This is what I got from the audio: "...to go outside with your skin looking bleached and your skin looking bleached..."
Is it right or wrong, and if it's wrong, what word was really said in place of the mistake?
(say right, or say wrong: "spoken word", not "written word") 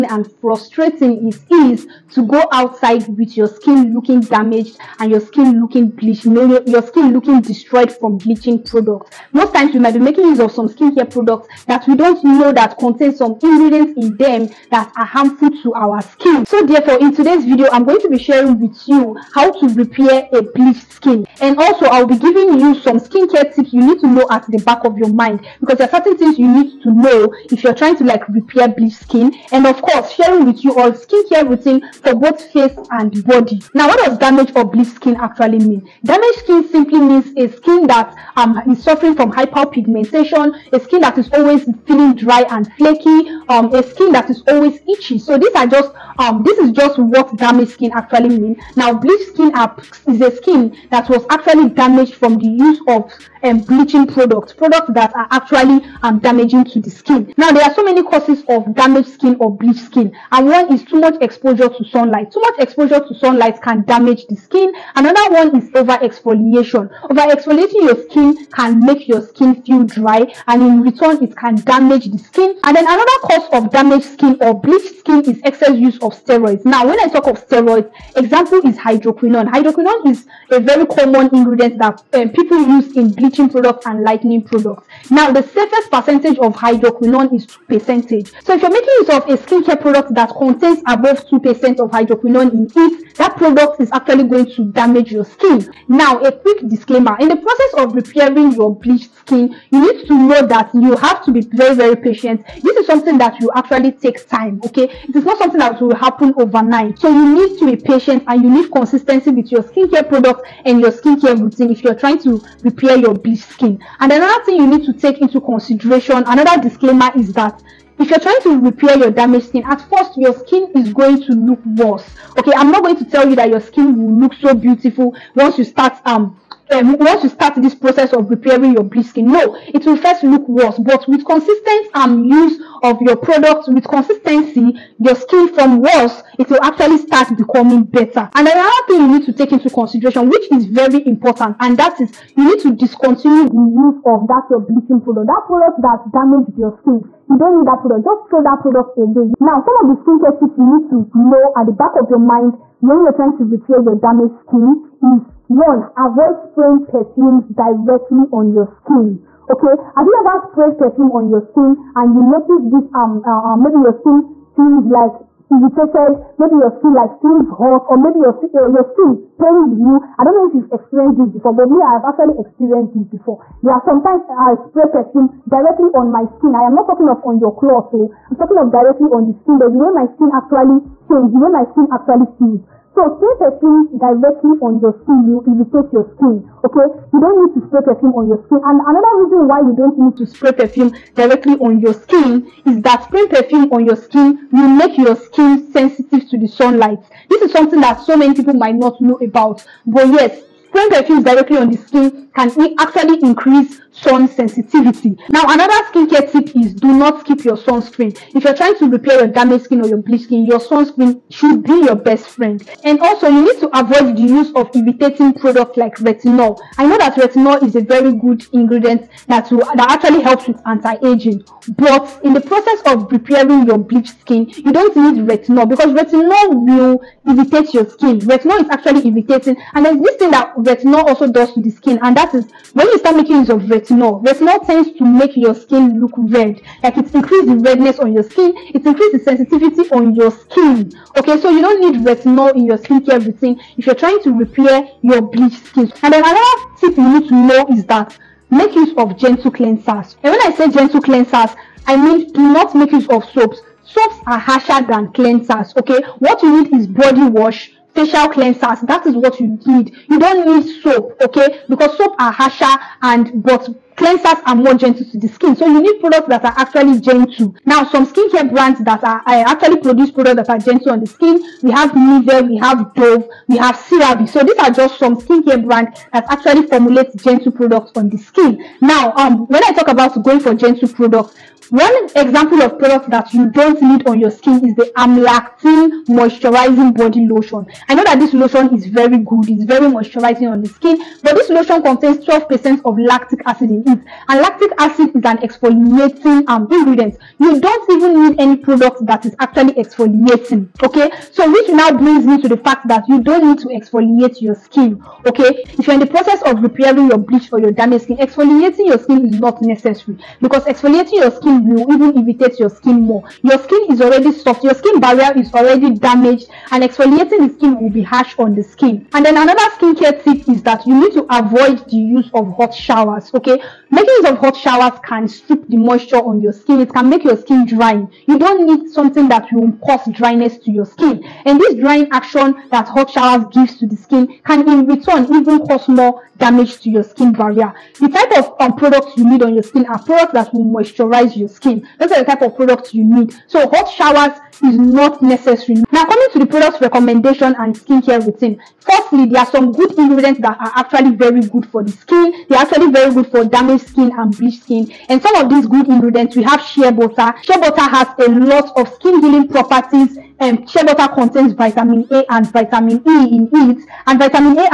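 wrong: "damaged", not "bleached".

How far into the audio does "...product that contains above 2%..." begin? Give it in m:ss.
1:29.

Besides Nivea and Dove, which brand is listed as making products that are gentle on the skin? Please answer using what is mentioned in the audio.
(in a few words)
CeraVe.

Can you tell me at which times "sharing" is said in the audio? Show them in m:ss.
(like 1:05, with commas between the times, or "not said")
0:18, 0:30.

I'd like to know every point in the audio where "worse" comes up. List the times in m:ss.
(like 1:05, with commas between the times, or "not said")
2:01, 2:10, 2:15.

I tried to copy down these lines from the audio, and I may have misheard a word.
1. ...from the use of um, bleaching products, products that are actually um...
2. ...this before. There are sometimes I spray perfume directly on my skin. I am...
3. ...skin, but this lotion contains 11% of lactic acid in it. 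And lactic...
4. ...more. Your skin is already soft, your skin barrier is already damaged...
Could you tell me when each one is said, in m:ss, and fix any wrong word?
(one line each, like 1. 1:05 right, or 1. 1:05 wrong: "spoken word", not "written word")
1. 0:52 right
2. 2:52 right
3. 4:50 wrong: "12", not "11"
4. 5:13 right.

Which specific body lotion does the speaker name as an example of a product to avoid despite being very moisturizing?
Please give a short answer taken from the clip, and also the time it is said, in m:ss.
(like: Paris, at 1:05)
Amlactin Moisturizing Body Lotion, at 4:44.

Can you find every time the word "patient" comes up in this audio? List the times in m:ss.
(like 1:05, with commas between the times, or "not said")
1:41, 1:47.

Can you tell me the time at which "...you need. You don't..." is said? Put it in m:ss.
4:19.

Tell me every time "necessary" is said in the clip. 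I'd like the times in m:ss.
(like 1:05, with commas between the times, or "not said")
5:09, 5:45.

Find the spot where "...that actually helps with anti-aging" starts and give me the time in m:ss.
3:39.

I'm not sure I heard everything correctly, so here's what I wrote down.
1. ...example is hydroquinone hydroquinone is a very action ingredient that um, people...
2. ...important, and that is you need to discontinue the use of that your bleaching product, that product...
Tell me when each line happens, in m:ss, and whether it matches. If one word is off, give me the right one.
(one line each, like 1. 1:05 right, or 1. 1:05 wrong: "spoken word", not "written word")
1. 1:18 wrong: "common", not "action"
2. 2:21 right.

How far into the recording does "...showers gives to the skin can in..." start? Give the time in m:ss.
5:33.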